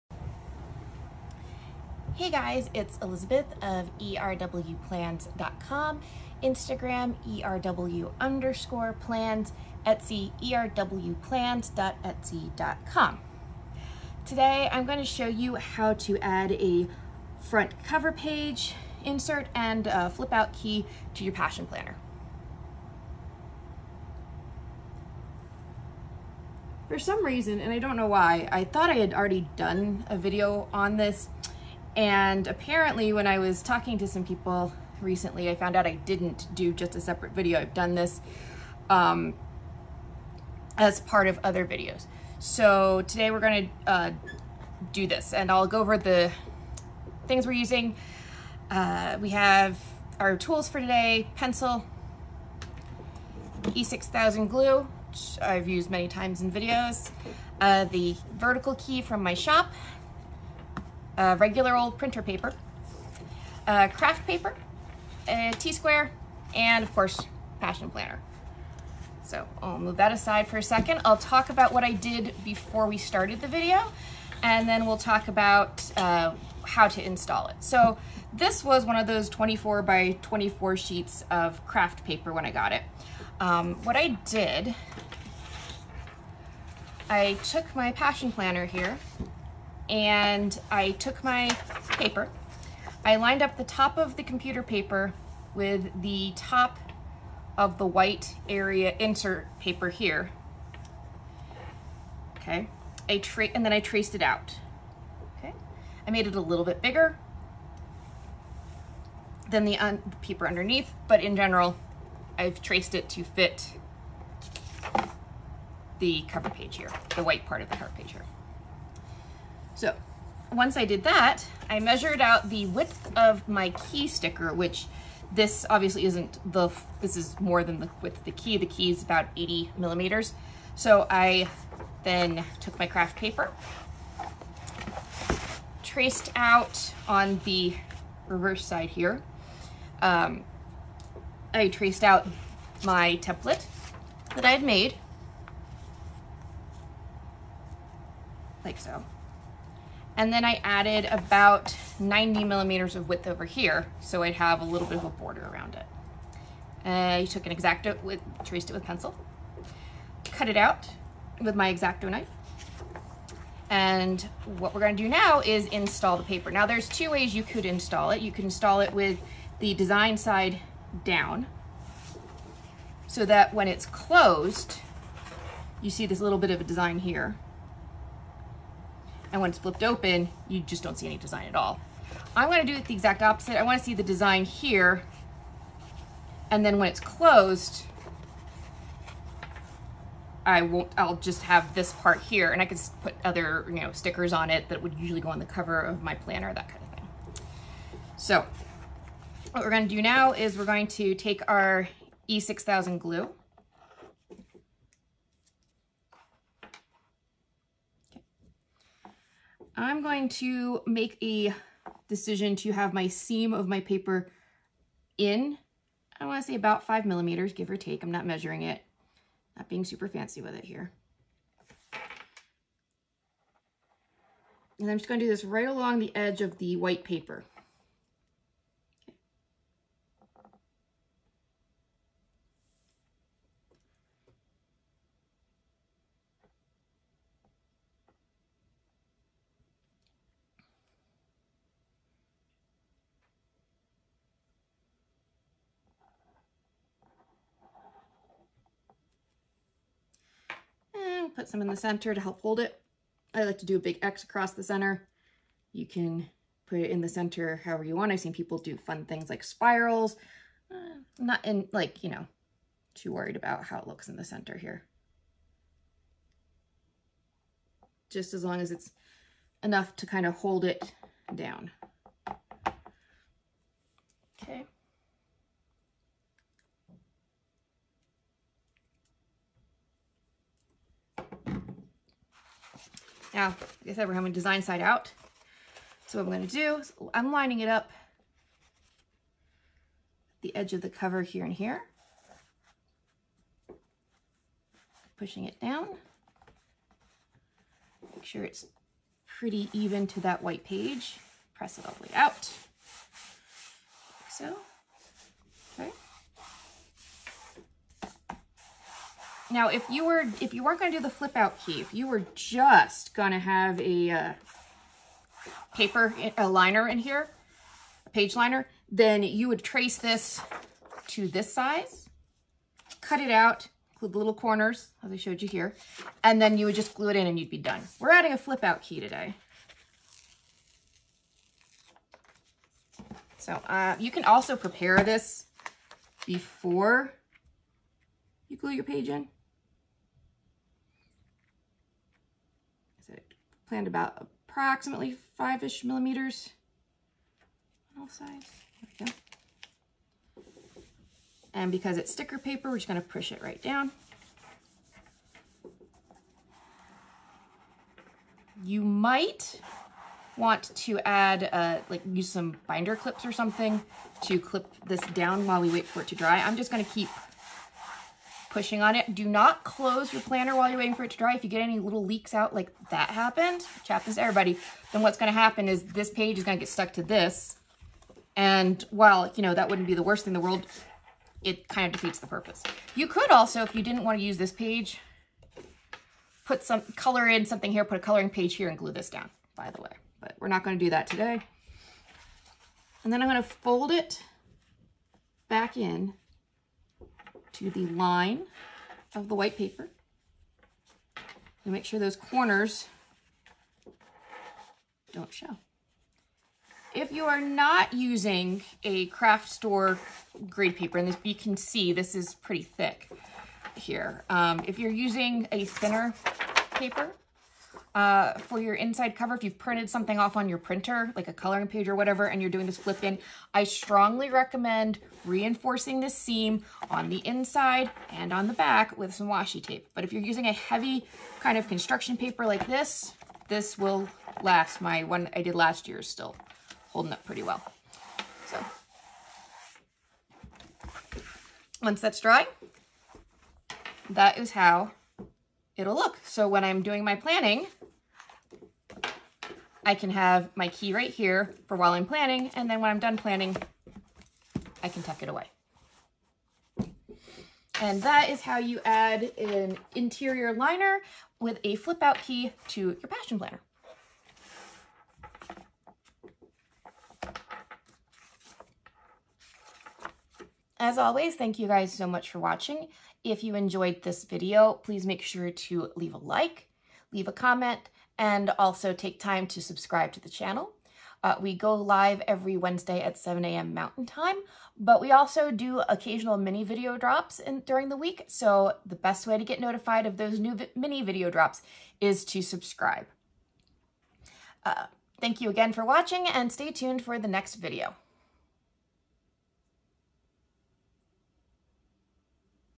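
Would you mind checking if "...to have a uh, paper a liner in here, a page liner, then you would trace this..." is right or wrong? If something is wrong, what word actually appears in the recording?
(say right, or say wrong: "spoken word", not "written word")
right.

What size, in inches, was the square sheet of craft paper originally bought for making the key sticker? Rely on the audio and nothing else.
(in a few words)
24 by 24.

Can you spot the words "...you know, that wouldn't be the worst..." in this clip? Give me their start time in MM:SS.
06:19.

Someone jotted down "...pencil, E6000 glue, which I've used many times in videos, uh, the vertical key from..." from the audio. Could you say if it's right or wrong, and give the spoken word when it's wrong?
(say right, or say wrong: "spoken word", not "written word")
right.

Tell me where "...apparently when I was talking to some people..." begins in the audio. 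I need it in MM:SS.
00:32.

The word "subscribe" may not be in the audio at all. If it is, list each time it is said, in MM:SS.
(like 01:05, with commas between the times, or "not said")
07:59, 08:12.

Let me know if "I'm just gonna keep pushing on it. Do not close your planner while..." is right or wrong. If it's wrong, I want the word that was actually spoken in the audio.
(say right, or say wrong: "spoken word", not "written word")
right.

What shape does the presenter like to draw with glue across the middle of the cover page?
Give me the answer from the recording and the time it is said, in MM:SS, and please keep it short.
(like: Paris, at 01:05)
a big X, at 04:13.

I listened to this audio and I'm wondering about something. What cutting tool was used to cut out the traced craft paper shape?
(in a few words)
X-Acto knife.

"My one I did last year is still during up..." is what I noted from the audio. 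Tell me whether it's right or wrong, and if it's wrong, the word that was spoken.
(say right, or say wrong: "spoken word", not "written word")
wrong: "holding", not "during".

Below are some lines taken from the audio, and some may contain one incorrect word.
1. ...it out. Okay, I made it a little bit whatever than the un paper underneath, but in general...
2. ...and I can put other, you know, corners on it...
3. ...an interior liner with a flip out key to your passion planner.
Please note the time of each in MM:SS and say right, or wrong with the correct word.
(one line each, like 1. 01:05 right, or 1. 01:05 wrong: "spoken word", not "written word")
1. 01:44 wrong: "bigger", not "whatever"
2. 03:12 wrong: "stickers", not "corners"
3. 07:39 right.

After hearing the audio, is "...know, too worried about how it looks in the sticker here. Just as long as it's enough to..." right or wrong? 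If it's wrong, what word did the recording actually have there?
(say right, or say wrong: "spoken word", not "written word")
wrong: "center", not "sticker".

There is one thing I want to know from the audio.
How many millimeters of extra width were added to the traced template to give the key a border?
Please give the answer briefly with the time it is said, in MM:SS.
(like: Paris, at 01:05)
90 millimeters, at 02:31.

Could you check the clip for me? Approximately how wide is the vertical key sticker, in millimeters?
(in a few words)
80 millimeters.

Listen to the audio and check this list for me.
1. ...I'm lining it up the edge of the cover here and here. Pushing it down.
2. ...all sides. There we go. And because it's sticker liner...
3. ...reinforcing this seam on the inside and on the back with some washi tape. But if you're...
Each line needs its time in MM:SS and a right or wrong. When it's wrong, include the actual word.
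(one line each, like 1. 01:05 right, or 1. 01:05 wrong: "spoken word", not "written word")
1. 04:47 right
2. 05:48 wrong: "paper", not "liner"
3. 07:05 right.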